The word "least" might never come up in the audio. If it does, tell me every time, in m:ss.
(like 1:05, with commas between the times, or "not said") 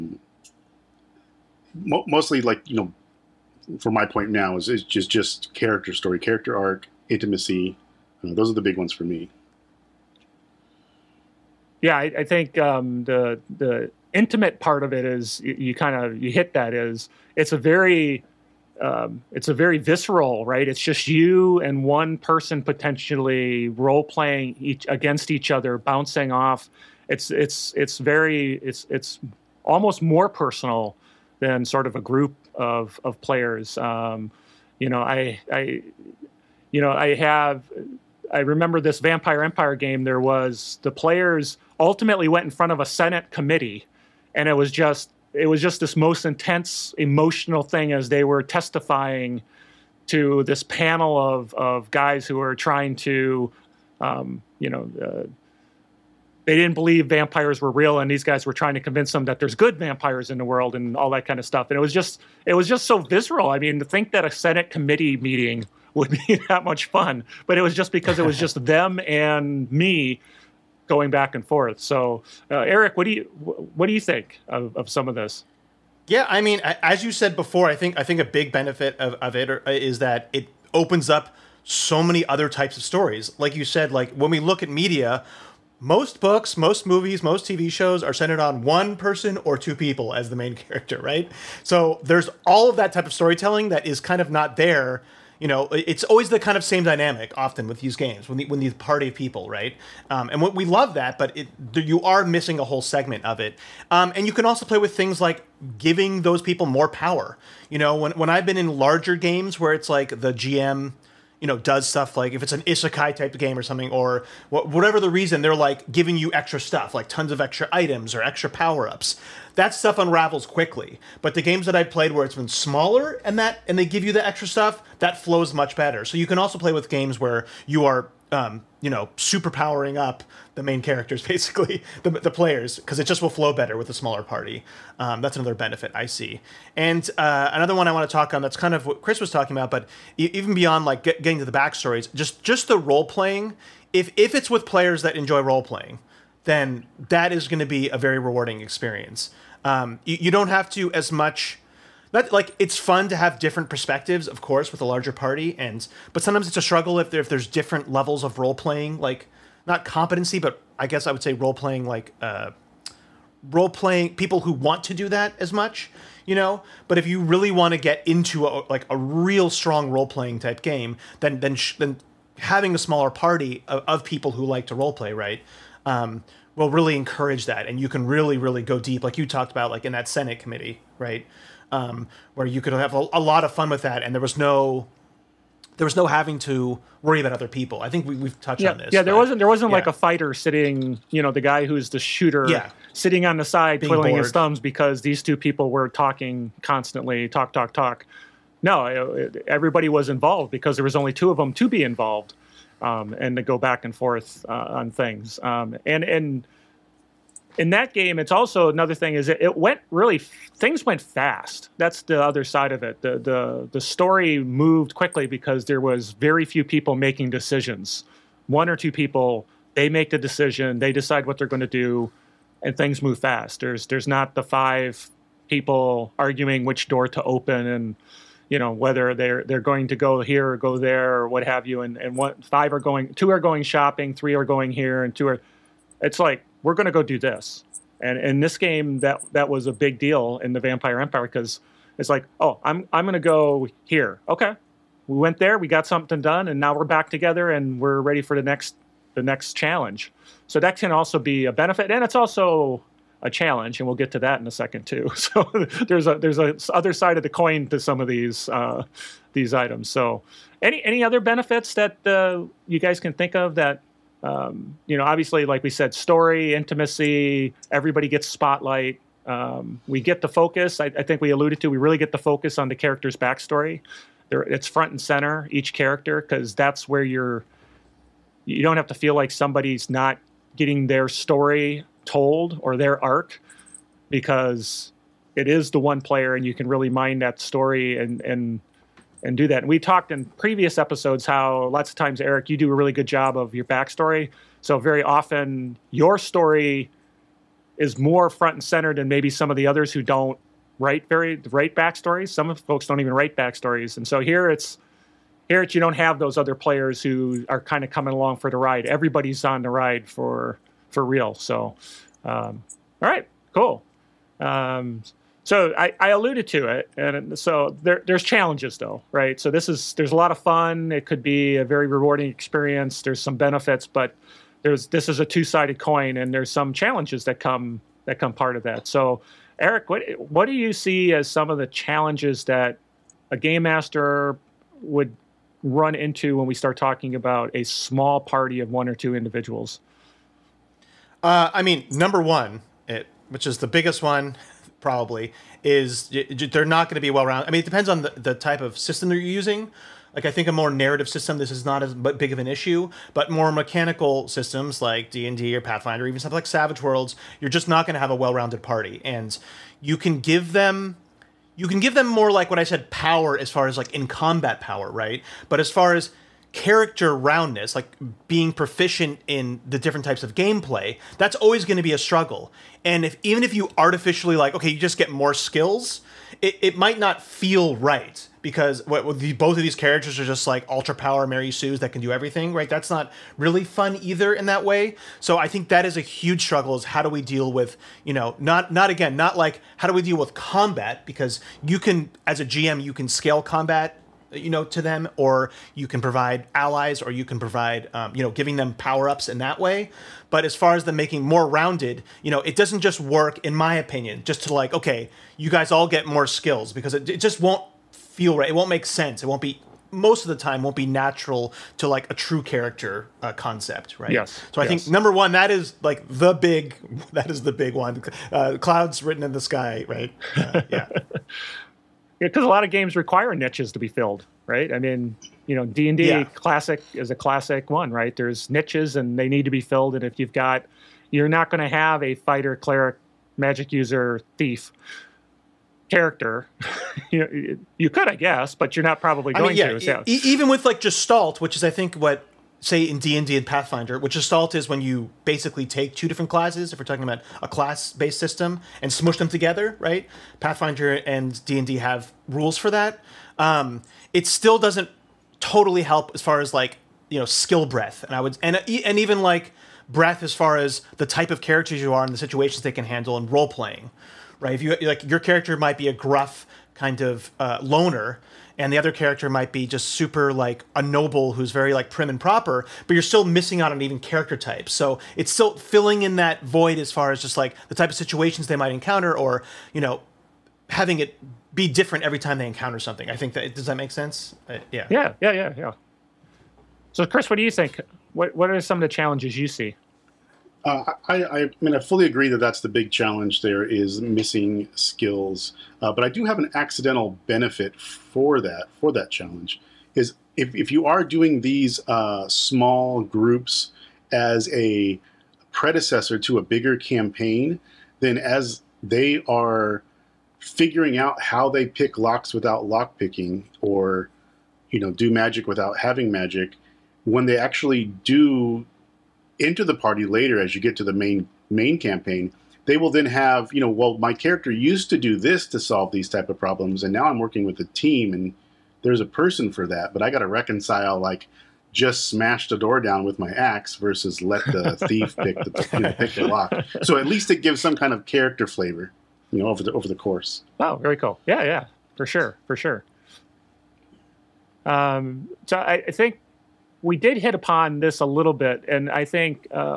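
8:57.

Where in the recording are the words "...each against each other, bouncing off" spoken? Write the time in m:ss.
0:24.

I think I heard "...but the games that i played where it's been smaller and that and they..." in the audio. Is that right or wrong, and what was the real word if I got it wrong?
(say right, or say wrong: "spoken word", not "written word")
right.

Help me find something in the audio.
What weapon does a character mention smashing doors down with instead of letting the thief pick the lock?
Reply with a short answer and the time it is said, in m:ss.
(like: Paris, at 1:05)
axe, at 8:53.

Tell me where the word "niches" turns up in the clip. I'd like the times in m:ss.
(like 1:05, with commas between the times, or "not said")
7:03, 7:08.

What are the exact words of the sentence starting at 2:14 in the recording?
Um, that's another benefit I see.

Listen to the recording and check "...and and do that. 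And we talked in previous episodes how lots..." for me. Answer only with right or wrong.
right.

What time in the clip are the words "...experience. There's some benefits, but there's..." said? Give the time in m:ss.
5:22.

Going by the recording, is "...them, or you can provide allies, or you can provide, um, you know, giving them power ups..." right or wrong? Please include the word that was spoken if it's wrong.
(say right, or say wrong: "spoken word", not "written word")
right.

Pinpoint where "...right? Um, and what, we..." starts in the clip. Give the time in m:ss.
1:39.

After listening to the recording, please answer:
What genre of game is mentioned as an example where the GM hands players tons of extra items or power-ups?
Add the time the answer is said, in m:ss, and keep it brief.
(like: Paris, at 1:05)
isekai, at 1:52.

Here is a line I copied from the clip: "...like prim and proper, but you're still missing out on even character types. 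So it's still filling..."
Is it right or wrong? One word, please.
right.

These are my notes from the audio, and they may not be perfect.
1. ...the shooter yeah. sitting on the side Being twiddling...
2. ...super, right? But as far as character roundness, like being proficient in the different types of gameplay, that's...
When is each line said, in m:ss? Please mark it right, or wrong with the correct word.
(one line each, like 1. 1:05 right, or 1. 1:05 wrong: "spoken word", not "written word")
1. 3:11 right
2. 6:04 wrong: "power", not "super".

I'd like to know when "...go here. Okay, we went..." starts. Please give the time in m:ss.
4:03.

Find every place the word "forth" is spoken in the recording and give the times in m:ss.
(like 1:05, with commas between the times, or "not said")
1:11, 3:23.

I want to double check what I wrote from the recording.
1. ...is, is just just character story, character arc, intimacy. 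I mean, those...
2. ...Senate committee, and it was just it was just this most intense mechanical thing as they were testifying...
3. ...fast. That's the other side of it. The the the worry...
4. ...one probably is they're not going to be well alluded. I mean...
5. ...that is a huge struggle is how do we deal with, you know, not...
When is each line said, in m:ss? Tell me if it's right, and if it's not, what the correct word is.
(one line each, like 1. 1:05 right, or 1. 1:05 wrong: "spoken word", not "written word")
1. 0:04 right
2. 0:42 wrong: "emotional", not "mechanical"
3. 3:31 wrong: "story", not "worry"
4. 5:44 wrong: "rounded", not "alluded"
5. 6:25 right.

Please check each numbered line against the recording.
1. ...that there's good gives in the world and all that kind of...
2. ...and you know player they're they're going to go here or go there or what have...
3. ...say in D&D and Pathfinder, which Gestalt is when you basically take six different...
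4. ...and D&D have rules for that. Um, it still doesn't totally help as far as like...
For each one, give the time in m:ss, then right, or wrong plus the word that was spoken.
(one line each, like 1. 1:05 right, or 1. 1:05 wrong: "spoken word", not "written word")
1. 0:59 wrong: "vampires", not "gives"
2. 3:47 wrong: "whether", not "player"
3. 7:22 wrong: "two", not "six"
4. 7:31 right.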